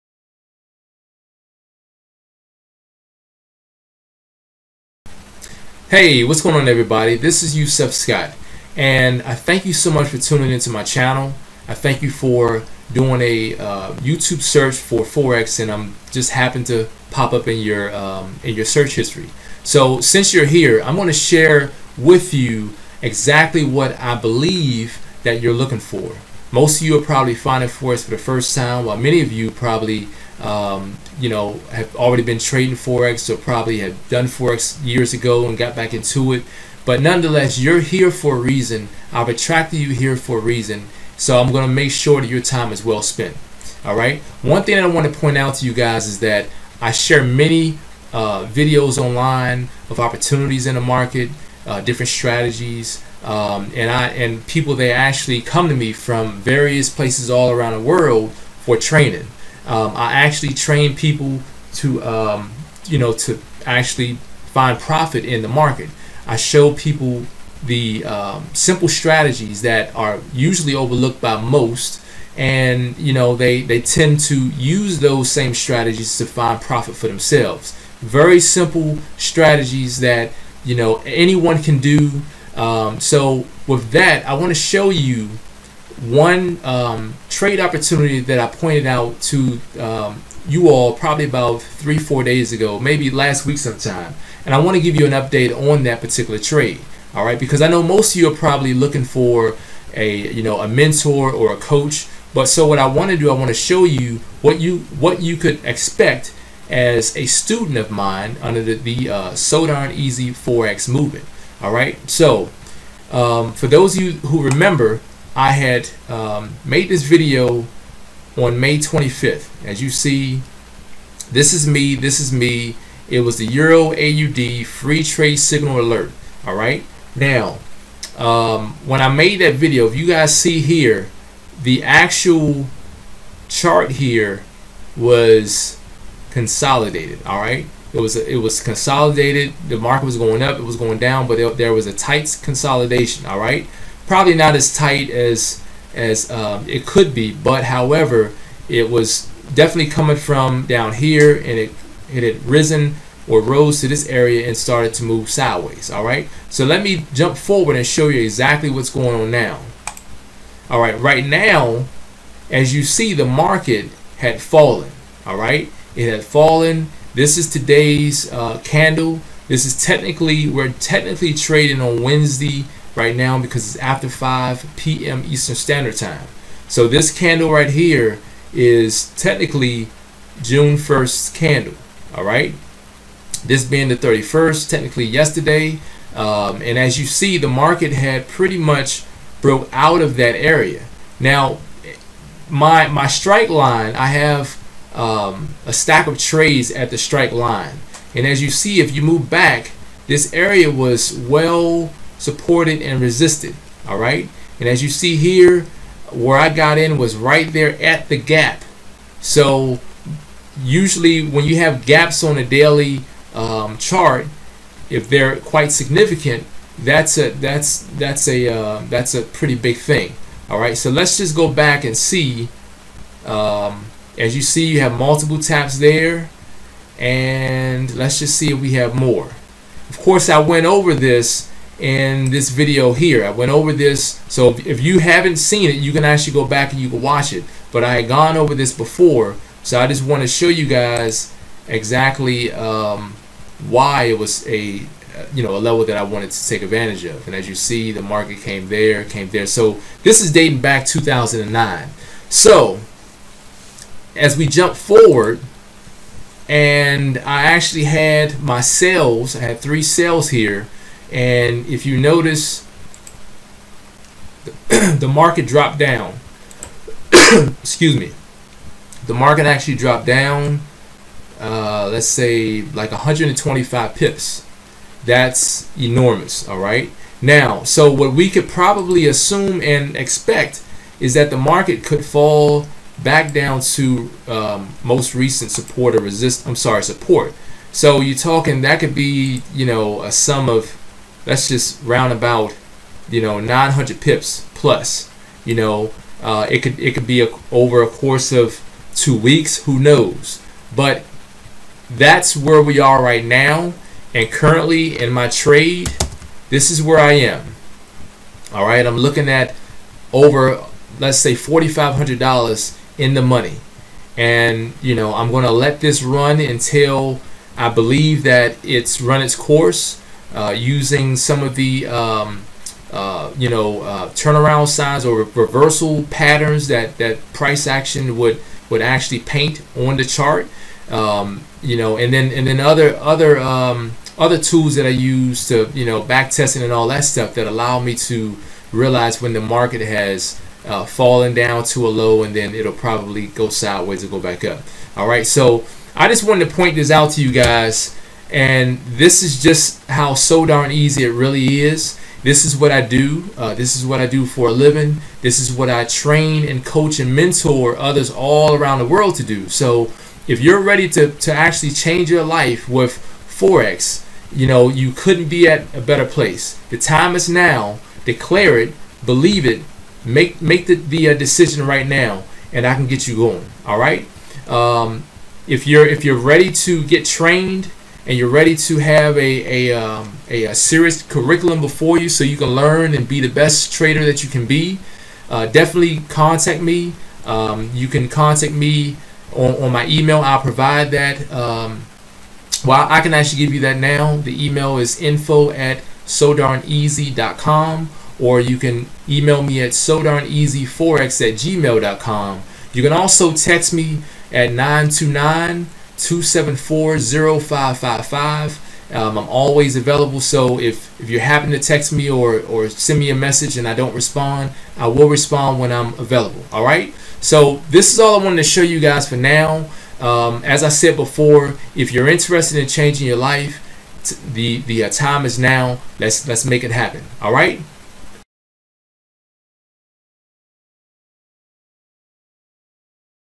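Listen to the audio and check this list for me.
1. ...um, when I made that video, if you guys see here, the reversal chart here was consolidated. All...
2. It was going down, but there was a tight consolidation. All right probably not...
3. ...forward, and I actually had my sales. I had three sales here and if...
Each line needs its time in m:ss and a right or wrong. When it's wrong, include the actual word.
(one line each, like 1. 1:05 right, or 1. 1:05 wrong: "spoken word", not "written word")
1. 2:08 wrong: "actual", not "reversal"
2. 2:20 right
3. 4:14 right.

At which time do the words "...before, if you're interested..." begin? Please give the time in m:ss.
7:00.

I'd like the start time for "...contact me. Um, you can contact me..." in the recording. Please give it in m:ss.
6:26.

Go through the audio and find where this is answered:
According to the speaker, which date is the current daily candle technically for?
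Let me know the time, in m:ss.
3:00.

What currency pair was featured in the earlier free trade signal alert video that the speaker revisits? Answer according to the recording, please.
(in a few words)
Euro AUD.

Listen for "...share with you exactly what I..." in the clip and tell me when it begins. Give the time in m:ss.
0:21.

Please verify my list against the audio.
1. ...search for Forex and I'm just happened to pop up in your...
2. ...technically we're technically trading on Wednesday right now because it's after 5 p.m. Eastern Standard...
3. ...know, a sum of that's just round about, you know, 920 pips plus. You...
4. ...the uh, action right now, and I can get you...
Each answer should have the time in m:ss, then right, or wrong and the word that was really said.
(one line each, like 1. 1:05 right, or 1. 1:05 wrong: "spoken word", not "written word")
1. 0:14 right
2. 2:49 right
3. 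4:49 wrong: "900", not "920"
4. 6:10 wrong: "decision", not "action".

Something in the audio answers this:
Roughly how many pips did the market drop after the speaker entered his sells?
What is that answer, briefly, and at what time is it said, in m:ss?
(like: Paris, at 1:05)
125 pips, at 4:32.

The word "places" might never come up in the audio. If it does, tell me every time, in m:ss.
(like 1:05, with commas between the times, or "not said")
0:56, 6:06.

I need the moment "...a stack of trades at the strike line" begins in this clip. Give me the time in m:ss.
3:15.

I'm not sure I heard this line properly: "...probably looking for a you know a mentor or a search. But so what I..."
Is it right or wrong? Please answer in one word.
wrong.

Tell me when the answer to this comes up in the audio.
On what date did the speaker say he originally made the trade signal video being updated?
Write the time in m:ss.
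1:58.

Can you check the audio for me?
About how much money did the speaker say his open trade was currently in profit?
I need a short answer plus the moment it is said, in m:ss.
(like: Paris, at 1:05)
$4,500, at 5:11.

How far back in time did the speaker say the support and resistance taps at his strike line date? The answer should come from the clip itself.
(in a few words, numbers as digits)
2009.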